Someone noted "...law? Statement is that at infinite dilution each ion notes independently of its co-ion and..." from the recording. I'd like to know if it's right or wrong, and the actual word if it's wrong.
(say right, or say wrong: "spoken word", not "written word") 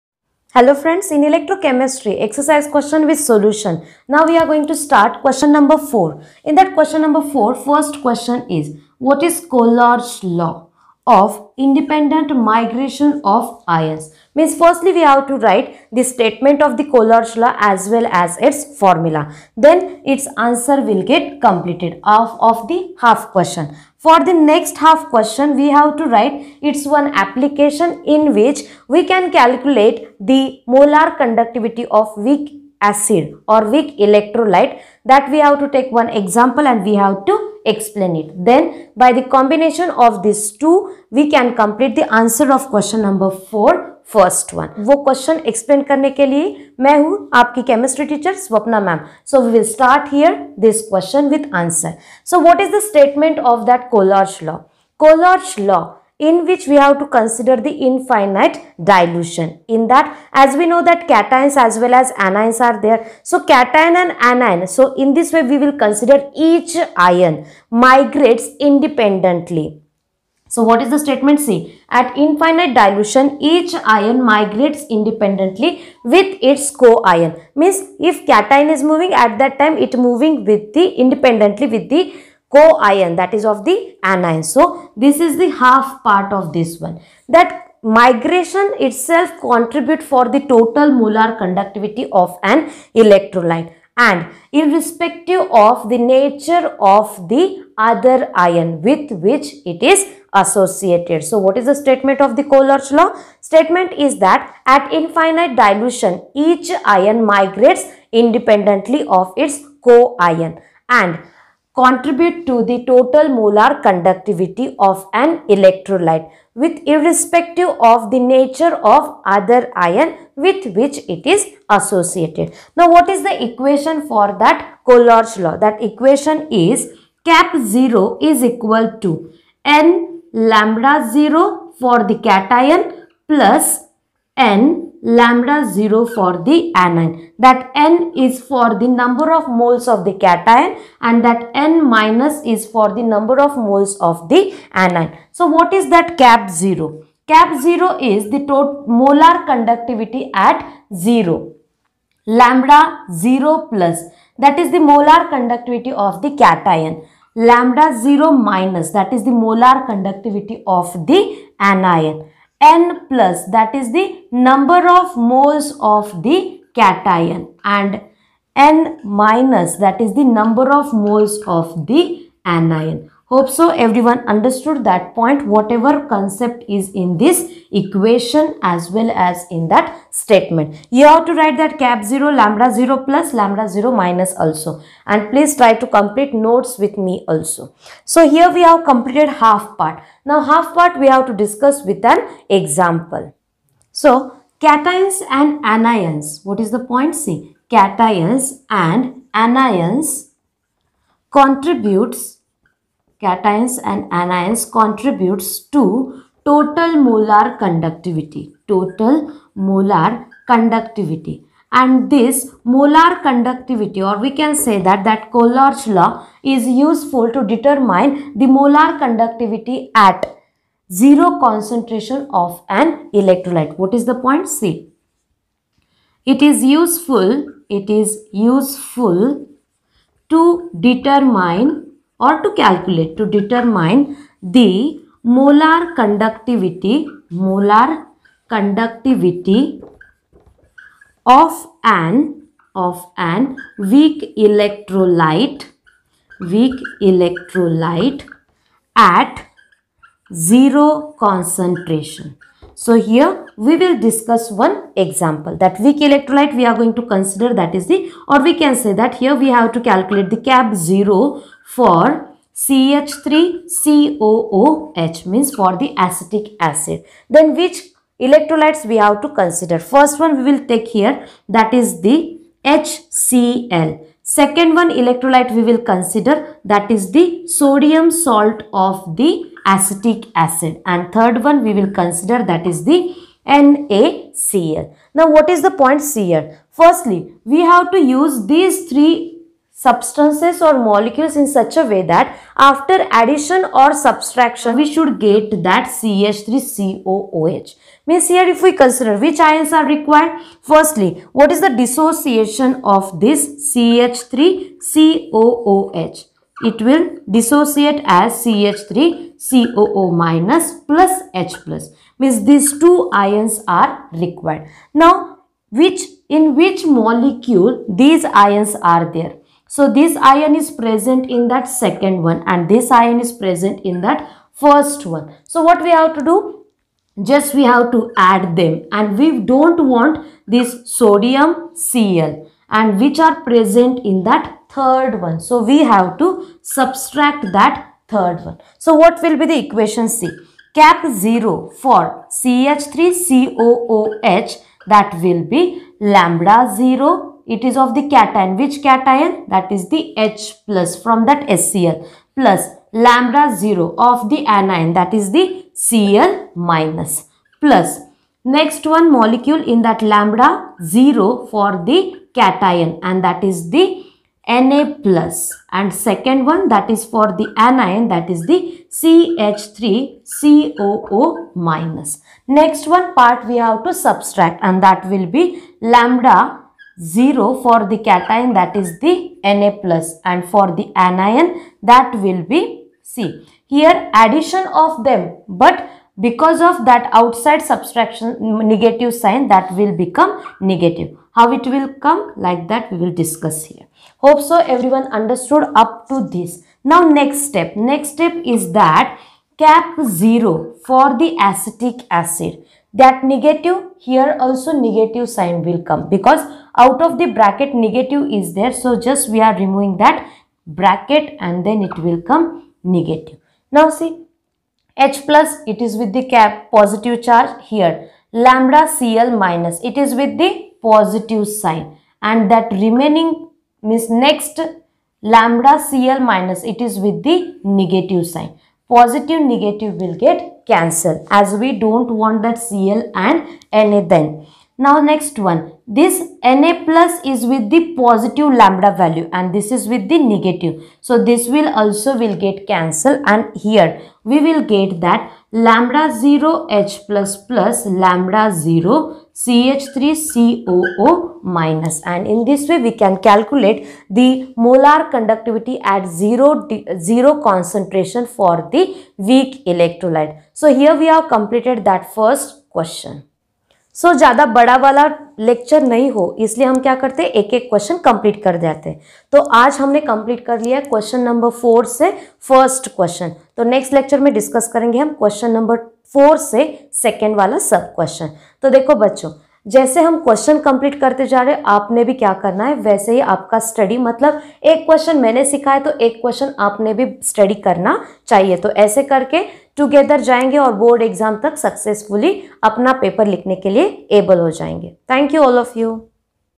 wrong: "migrates", not "notes".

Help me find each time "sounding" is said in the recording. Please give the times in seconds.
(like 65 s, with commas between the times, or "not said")
not said.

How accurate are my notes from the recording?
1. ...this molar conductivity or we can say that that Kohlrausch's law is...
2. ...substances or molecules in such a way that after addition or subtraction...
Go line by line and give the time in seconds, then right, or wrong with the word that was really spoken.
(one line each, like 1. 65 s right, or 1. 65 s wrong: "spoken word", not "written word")
1. 212 s right
2. 289 s right.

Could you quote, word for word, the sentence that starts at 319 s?
So this ion is present in that second one and this ion is present in that first one.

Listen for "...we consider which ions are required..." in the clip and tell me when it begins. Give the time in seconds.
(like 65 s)
298 s.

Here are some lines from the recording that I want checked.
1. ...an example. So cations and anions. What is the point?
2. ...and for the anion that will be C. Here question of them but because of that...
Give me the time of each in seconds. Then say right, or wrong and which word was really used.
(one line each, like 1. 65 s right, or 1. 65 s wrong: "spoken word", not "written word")
1. 192 s right
2. 380 s wrong: "addition", not "question".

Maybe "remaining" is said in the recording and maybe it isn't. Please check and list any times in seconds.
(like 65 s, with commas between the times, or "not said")
422 s.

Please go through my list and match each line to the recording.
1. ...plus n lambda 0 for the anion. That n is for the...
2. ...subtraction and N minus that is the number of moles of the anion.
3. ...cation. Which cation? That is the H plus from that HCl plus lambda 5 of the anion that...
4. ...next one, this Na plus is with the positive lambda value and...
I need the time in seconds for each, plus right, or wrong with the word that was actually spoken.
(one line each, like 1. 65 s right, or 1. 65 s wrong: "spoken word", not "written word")
1. 133 s right
2. 166 s wrong: "cation", not "subtraction"
3. 348 s wrong: "0", not "5"
4. 435 s right.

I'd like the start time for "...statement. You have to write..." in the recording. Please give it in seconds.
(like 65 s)
180 s.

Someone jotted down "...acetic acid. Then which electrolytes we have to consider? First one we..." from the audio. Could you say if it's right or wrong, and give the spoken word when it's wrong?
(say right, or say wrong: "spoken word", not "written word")
right.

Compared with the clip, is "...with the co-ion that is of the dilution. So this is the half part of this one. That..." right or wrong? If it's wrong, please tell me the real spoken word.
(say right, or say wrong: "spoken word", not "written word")
wrong: "anion", not "dilution".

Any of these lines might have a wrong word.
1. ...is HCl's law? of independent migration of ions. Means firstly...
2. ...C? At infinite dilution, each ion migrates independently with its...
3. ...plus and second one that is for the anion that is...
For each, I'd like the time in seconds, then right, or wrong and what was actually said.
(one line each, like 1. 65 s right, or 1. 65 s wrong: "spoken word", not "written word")
1. 9 s wrong: "Kohlrausch", not "HCl"
2. 71 s right
3. 365 s right.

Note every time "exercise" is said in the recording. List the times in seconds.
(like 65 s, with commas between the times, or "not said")
2 s.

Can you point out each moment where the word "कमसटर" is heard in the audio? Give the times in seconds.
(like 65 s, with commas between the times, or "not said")
47 s.